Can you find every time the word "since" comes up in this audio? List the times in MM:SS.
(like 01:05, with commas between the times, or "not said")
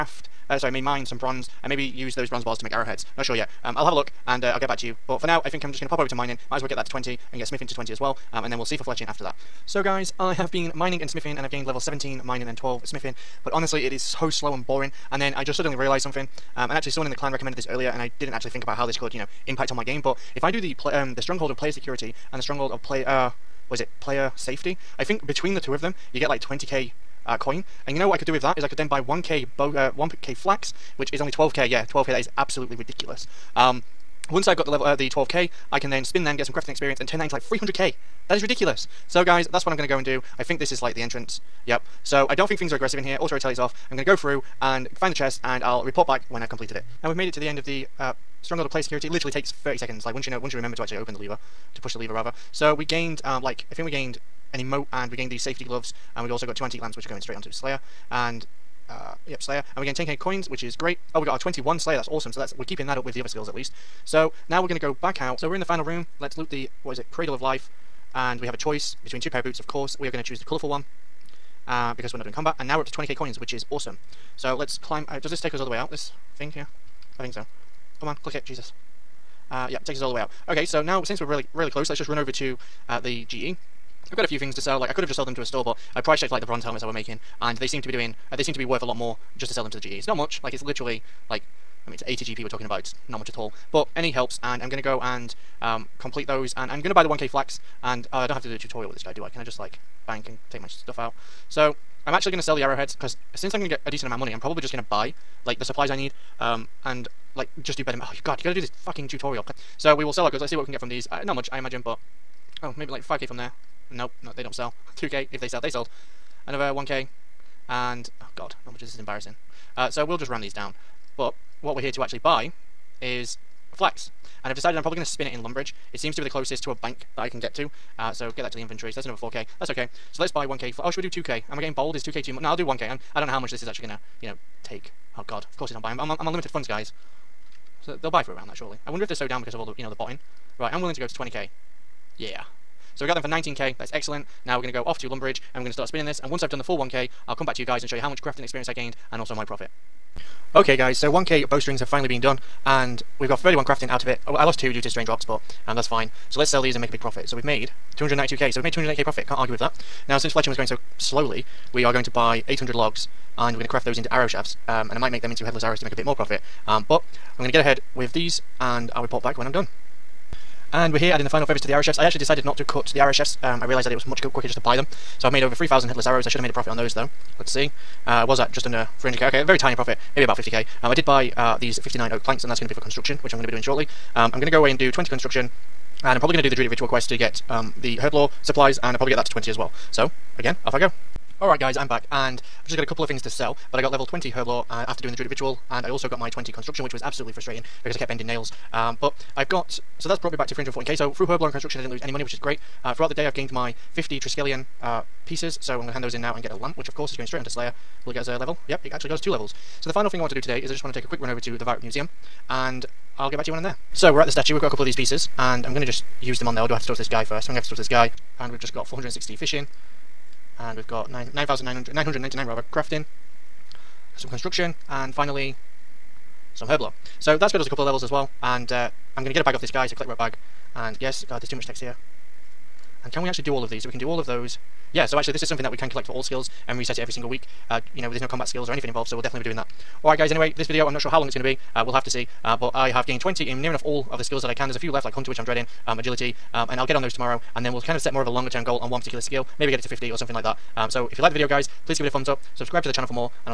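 01:21, 01:43, 02:40.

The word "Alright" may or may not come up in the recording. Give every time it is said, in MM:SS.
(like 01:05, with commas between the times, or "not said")
03:11, 04:00.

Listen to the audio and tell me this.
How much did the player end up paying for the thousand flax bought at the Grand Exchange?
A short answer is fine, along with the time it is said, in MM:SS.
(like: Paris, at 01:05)
19k, at 02:22.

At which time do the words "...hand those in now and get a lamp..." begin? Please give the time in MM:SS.
03:25.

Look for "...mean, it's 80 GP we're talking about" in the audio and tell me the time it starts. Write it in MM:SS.
01:31.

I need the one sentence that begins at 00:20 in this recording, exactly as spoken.
But if I do the um, the stronghold of player security and the stronghold of player, uh, was it player safety?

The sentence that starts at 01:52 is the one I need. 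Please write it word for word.
Oh, maybe like 5k from there.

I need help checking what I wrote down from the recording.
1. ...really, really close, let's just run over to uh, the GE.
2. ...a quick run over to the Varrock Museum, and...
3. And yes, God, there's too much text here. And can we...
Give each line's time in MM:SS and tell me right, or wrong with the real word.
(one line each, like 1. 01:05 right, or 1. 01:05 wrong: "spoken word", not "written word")
1. 01:21 right
2. 03:31 right
3. 03:50 right.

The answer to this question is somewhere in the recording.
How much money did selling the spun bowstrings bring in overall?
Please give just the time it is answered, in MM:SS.
02:37.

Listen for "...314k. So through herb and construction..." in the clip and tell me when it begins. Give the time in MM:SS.
03:20.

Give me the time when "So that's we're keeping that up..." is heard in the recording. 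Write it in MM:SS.
01:02.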